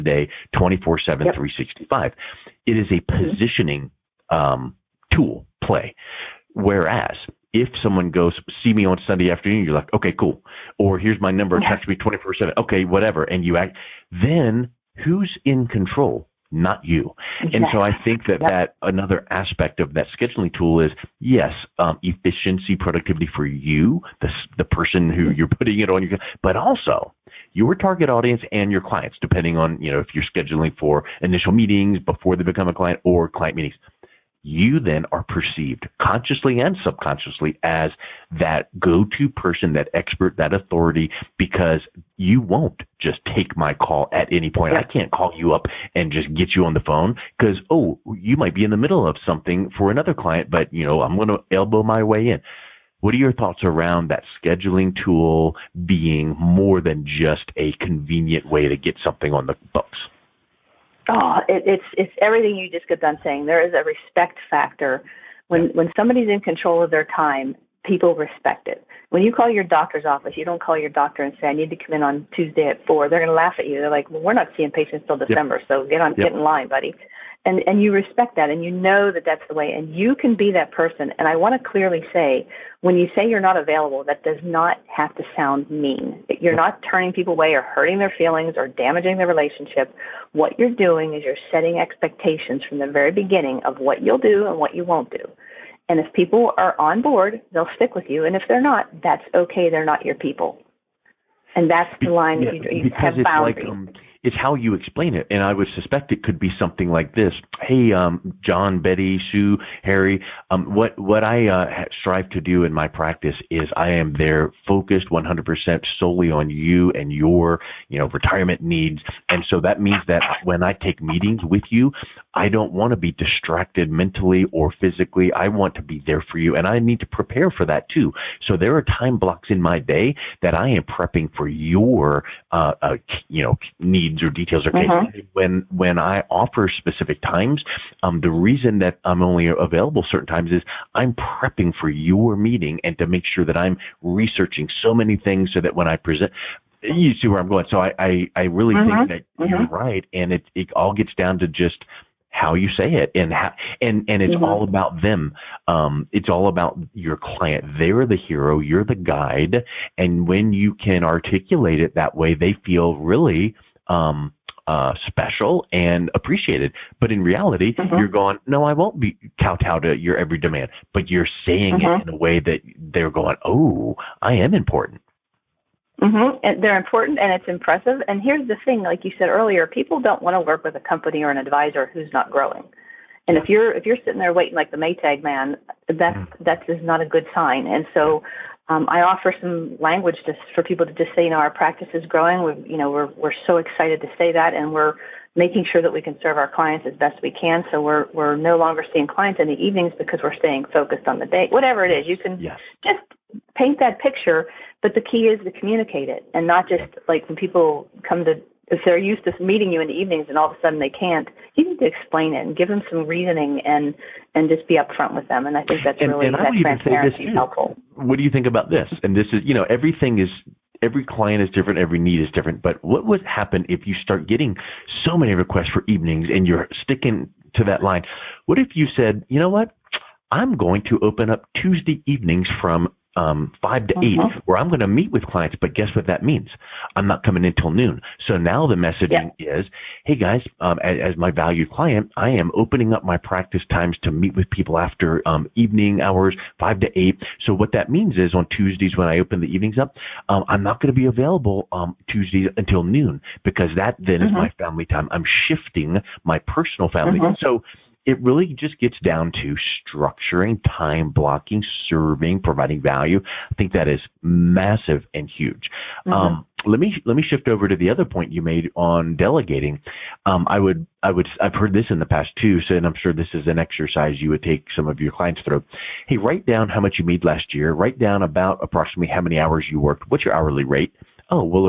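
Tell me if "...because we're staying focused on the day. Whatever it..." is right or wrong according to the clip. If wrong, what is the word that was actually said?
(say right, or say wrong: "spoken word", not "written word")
right.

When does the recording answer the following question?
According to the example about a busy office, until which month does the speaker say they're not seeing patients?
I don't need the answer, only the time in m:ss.
1:15.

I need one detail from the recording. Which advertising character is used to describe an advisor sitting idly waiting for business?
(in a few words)
The Maytag man.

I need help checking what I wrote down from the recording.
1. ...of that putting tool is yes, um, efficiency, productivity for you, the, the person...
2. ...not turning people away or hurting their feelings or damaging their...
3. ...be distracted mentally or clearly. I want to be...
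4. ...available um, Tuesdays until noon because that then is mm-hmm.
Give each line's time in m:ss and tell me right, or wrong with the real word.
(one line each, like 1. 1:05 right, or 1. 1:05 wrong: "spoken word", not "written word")
1. 0:19 wrong: "scheduling", not "putting"
2. 1:26 right
3. 2:02 wrong: "physically", not "clearly"
4. 4:11 right.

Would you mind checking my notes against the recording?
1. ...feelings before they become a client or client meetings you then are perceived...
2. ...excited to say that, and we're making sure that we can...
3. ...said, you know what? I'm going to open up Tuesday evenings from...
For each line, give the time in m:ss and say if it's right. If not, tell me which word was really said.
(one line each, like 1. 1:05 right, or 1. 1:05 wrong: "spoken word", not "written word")
1. 0:31 wrong: "meetings", not "feelings"
2. 3:13 right
3. 3:48 right.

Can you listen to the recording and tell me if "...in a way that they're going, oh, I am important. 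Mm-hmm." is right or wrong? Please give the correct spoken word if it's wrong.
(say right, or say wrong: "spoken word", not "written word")
right.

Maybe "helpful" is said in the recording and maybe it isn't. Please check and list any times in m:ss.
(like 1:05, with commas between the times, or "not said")
3:37.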